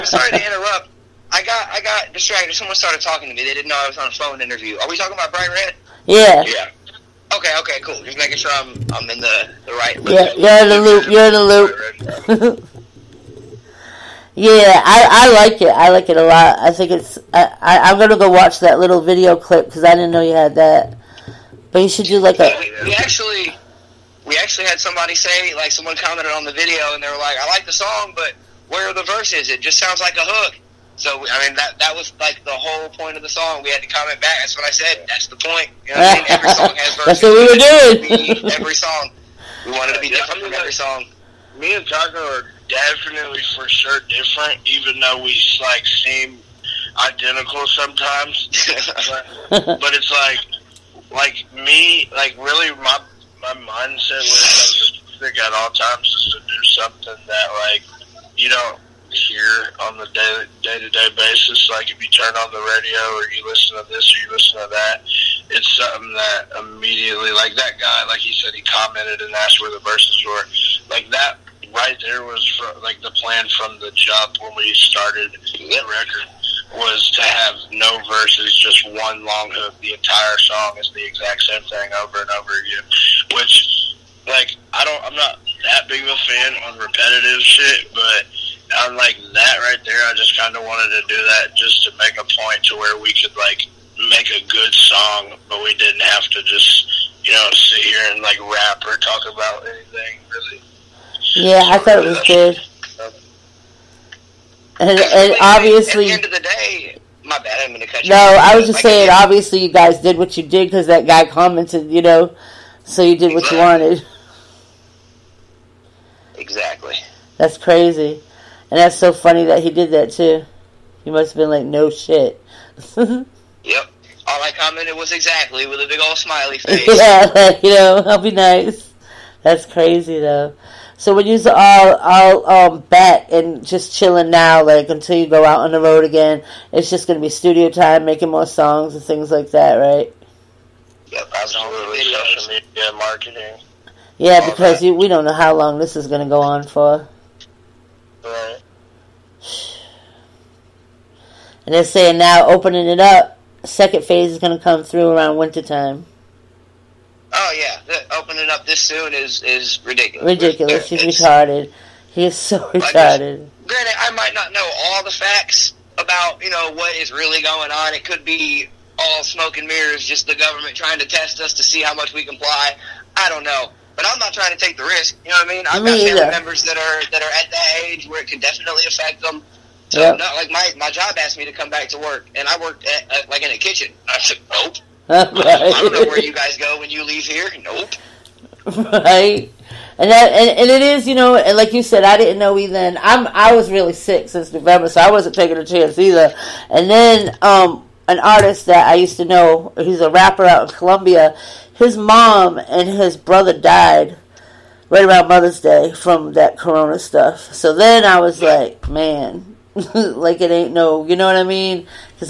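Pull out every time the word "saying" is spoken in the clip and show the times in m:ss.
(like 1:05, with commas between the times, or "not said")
1:48, 2:31.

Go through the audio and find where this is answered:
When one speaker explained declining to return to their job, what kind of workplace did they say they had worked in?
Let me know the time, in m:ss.
3:03.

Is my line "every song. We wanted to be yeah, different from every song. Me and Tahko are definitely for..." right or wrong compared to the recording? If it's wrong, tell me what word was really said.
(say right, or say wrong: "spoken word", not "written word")
right.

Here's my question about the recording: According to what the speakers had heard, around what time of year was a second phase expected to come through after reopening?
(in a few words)
Wintertime.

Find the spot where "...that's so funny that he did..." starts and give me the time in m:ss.
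1:58.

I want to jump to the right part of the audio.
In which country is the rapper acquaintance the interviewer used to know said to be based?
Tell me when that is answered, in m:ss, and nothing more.
3:20.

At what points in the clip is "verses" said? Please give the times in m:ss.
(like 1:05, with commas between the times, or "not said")
0:29, 0:36, 1:09, 1:18.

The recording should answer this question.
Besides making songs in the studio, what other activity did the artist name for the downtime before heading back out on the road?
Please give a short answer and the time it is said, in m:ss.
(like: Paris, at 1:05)
Social media marketing, at 2:22.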